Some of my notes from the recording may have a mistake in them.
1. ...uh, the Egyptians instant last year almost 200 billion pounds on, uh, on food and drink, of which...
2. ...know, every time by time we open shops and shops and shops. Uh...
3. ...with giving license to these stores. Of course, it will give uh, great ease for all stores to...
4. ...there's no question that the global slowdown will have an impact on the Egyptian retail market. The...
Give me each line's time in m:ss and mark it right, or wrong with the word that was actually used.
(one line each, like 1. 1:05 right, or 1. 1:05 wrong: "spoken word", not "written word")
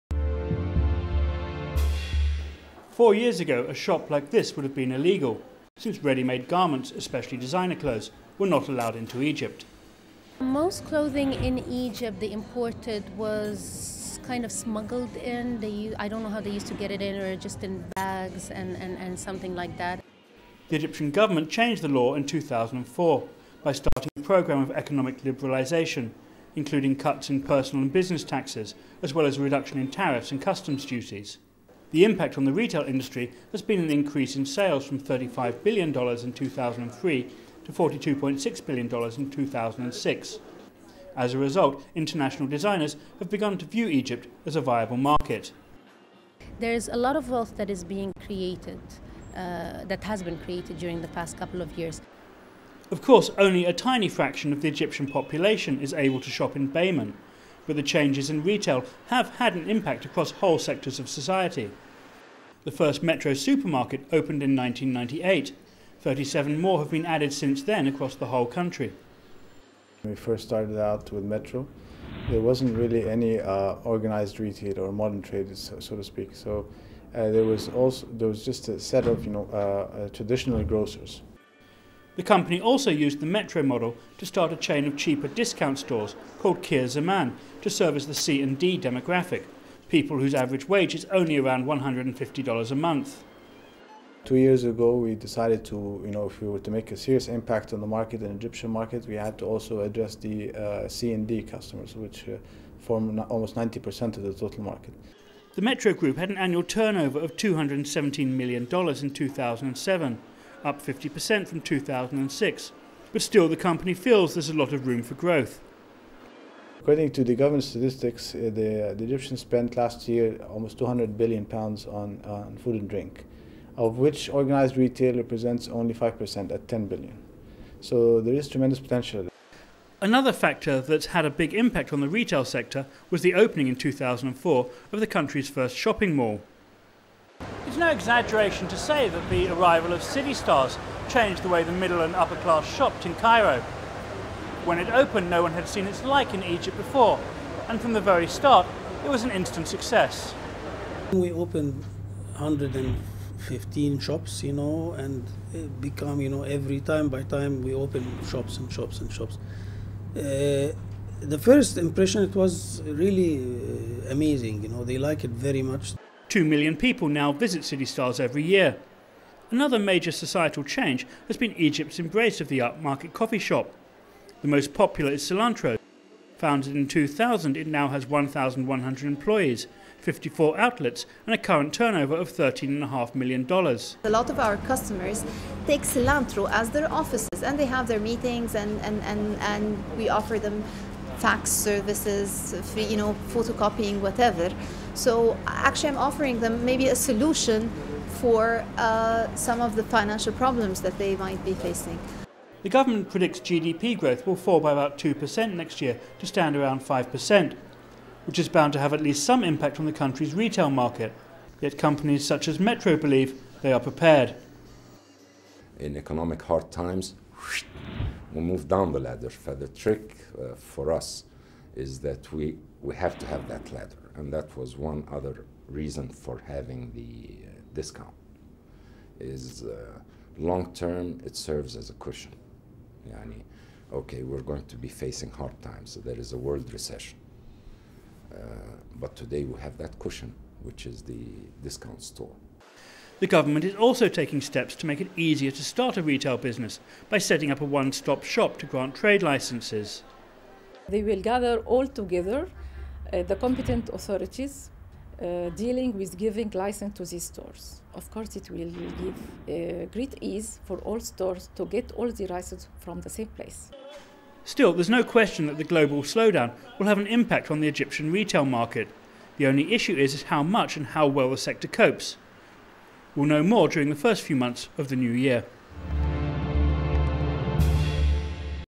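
1. 1:58 wrong: "spent", not "instant"
2. 2:36 right
3. 4:15 right
4. 4:24 right.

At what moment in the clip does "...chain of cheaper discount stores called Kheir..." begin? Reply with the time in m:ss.
1:24.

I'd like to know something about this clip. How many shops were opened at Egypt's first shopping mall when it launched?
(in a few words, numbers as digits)
115.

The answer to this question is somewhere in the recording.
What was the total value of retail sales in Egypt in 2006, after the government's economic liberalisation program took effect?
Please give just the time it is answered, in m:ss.
0:37.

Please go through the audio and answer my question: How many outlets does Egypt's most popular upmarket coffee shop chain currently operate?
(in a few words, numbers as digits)
54.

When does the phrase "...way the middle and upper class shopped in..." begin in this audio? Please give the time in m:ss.
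2:21.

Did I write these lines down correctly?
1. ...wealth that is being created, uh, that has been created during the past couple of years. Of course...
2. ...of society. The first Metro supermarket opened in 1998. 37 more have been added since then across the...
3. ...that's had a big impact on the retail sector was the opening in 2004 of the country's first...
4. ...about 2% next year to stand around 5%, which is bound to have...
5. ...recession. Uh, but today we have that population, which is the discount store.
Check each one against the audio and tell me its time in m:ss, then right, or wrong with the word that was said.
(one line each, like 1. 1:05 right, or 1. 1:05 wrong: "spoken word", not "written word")
1. 0:47 right
2. 1:00 right
3. 2:10 right
4. 3:24 right
5. 3:56 wrong: "cushion", not "population".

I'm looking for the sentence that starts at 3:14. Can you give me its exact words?
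So actually, I'm offering them maybe a solution for uh, some of the financial problems that they might be facing.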